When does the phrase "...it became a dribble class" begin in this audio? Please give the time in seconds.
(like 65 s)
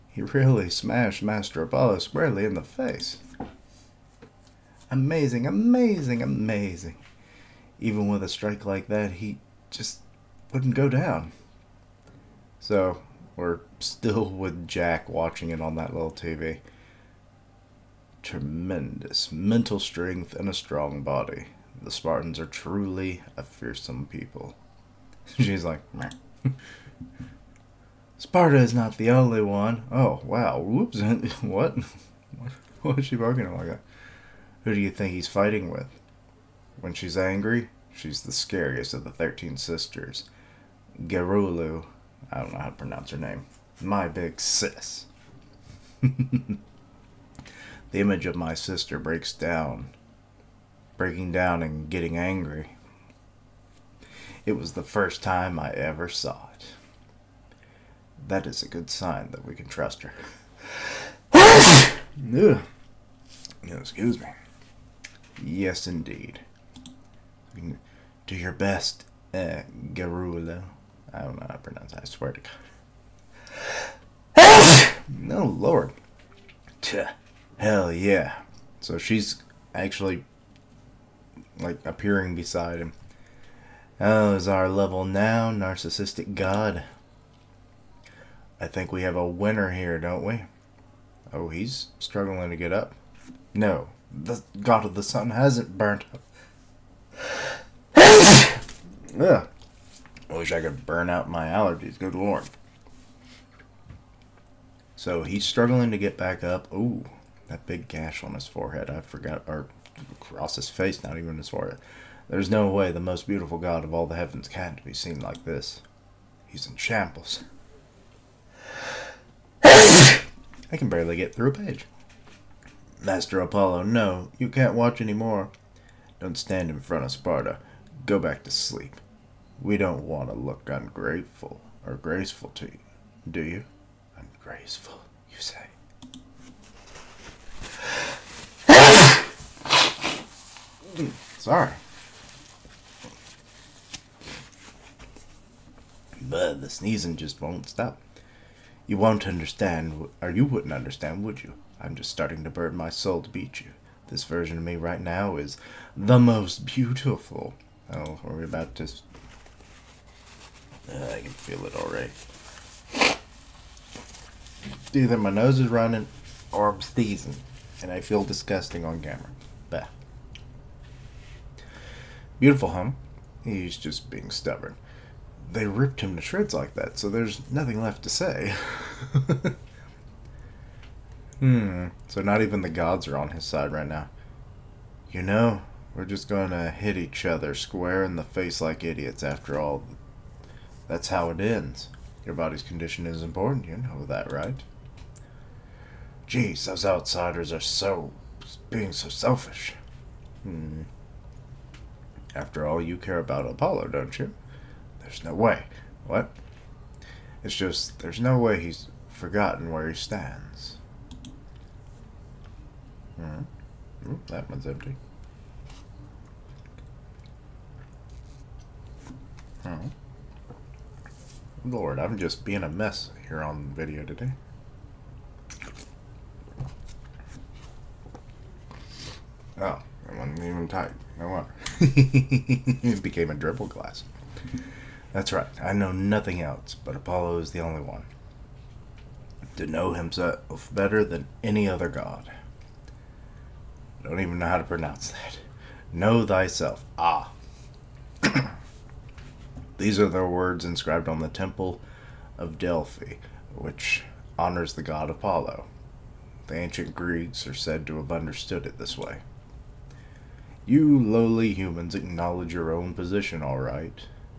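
231 s.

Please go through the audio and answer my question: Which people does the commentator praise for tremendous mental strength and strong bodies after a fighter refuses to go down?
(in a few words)
The Spartans.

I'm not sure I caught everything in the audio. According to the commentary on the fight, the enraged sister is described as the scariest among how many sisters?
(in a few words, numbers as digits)
13.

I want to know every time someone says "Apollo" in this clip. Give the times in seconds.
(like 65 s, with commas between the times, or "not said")
1 s, 123 s, 203 s, 236 s, 255 s.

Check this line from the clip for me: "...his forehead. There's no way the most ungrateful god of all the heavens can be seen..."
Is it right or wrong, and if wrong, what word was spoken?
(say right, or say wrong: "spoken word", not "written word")
wrong: "beautiful", not "ungrateful".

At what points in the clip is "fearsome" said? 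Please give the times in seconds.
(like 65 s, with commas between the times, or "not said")
23 s.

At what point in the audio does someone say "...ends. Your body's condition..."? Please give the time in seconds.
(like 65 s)
191 s.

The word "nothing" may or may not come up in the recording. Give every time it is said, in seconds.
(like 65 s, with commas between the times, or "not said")
177 s, 235 s.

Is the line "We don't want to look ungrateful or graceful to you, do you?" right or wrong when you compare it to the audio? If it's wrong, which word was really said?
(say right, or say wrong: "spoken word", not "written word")
right.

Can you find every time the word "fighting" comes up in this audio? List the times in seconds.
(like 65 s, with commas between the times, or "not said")
35 s.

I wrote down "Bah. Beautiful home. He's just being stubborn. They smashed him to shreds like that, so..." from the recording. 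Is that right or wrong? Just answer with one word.
wrong.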